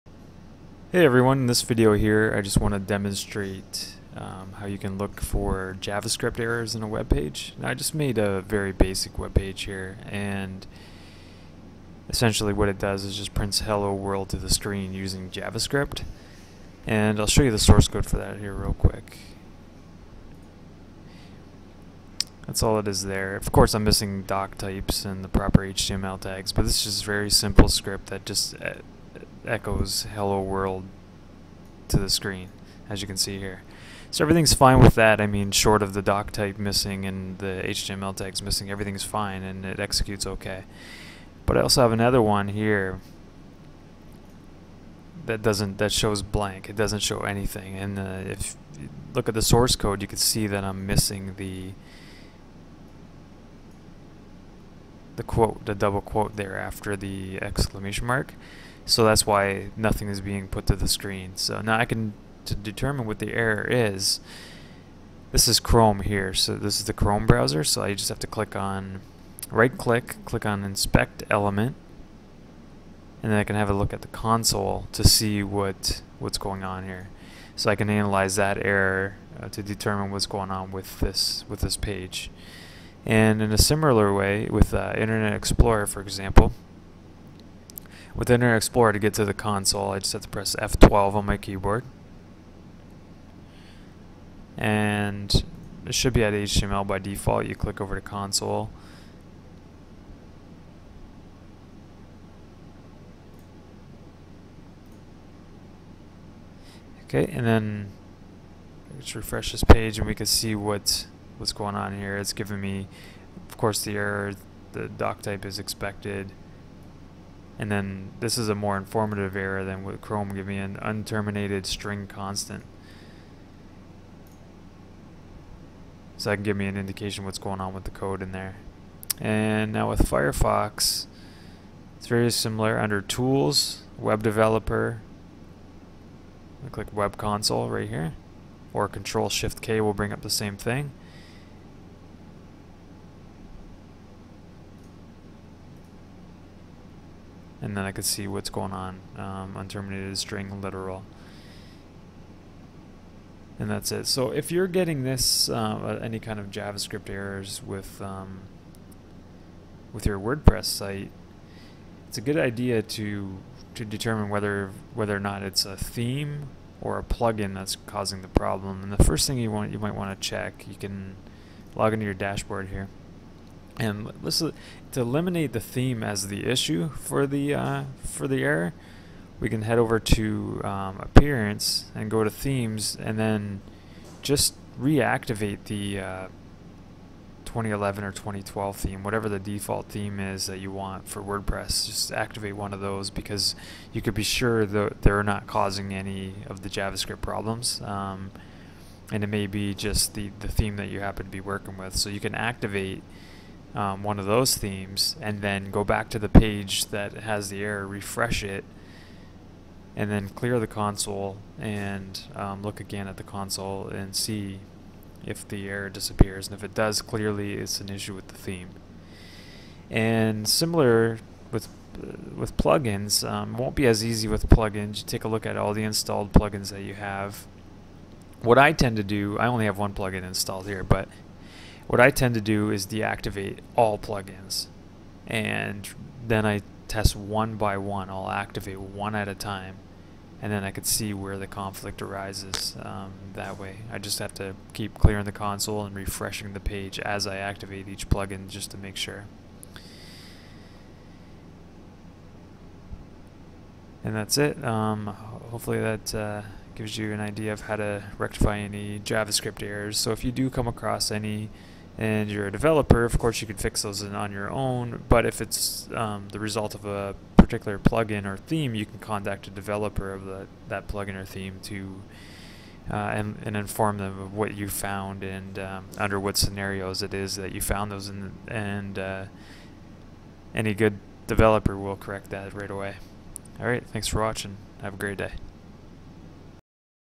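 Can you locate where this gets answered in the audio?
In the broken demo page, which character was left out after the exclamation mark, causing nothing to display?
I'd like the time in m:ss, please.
0:55.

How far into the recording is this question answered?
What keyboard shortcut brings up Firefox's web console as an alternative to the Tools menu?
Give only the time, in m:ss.
2:18.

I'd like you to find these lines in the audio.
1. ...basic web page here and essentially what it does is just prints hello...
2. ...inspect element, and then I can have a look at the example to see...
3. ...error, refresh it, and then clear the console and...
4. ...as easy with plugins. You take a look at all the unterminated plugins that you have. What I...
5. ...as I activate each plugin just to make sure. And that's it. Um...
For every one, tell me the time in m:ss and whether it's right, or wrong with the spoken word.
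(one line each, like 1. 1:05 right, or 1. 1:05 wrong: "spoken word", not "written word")
1. 0:08 right
2. 1:10 wrong: "console", not "example"
3. 3:27 right
4. 3:43 wrong: "installed", not "unterminated"
5. 4:06 right.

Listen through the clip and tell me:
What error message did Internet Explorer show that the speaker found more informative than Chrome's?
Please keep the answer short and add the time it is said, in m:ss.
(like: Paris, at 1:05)
unterminated string constant, at 2:00.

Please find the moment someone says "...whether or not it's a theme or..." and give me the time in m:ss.
2:44.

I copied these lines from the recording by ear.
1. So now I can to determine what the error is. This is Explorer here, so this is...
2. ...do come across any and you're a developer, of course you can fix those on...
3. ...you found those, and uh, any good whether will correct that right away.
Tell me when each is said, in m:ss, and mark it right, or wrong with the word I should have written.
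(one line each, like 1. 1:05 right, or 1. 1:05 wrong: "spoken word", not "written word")
1. 1:01 wrong: "Chrome", not "Explorer"
2. 4:20 right
3. 4:37 wrong: "developer", not "whether".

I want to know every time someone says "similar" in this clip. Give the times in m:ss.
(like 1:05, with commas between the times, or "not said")
1:23, 2:12, 3:40.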